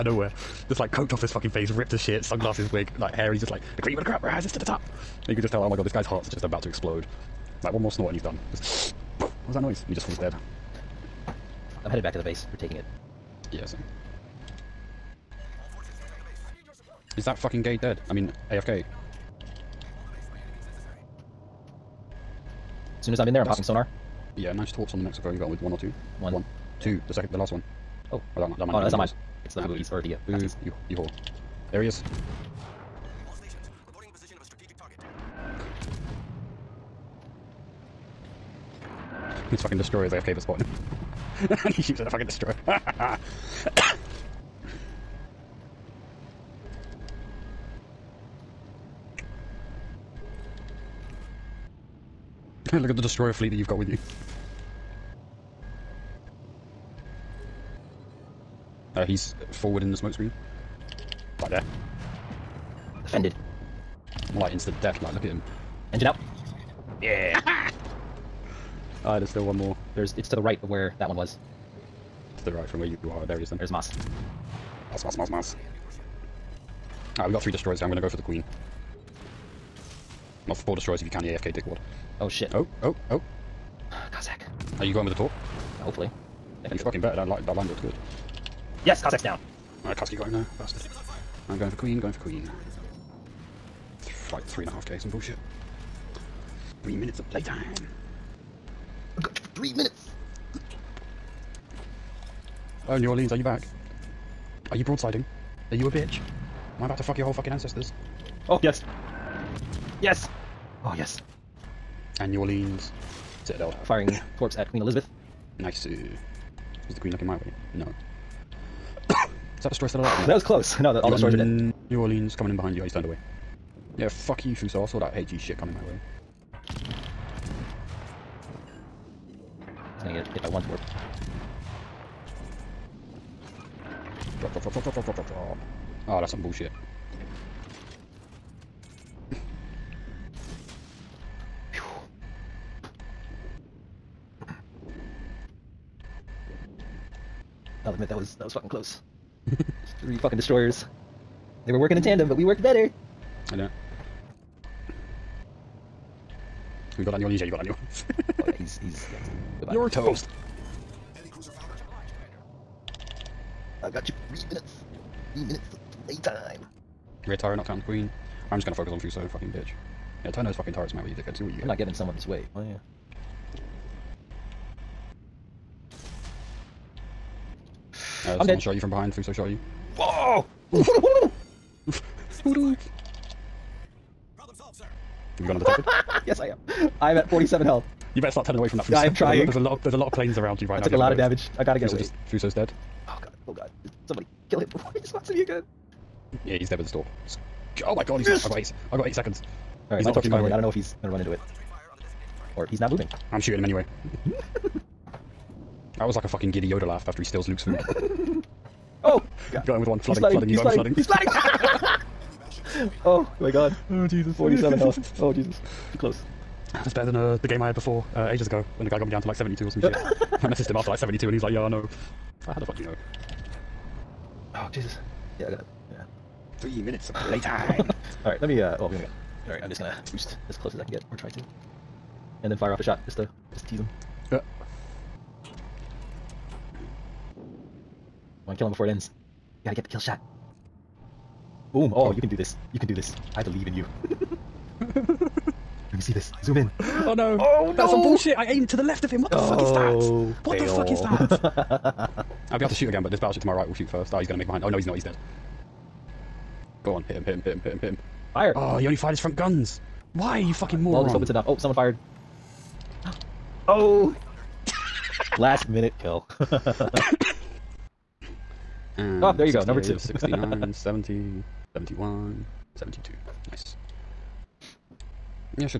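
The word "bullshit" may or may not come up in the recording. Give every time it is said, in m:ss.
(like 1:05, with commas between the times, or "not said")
1:35, 2:16, 4:08.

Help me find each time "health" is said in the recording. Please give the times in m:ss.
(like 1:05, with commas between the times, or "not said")
3:07, 3:34.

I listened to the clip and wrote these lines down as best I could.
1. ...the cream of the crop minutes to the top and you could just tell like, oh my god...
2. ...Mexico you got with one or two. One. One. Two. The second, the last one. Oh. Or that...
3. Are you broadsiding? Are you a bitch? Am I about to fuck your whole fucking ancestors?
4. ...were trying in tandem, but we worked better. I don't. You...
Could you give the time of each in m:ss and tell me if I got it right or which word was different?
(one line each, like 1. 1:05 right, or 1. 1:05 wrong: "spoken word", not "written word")
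1. 0:03 wrong: "rises", not "minutes"
2. 0:25 right
3. 1:44 right
4. 2:31 wrong: "working", not "trying".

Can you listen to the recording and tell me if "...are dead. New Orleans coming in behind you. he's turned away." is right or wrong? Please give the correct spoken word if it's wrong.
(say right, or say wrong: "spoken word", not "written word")
right.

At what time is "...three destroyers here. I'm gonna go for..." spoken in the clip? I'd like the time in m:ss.
1:17.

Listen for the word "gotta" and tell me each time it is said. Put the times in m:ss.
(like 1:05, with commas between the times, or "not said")
3:11, 3:45, 3:59.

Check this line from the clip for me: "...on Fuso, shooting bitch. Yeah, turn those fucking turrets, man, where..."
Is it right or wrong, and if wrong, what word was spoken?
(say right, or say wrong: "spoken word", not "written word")
wrong: "fucking", not "shooting".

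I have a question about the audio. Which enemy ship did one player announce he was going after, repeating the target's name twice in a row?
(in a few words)
Queen Elizabeth.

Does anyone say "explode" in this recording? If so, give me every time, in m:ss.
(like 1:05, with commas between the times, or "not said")
0:06.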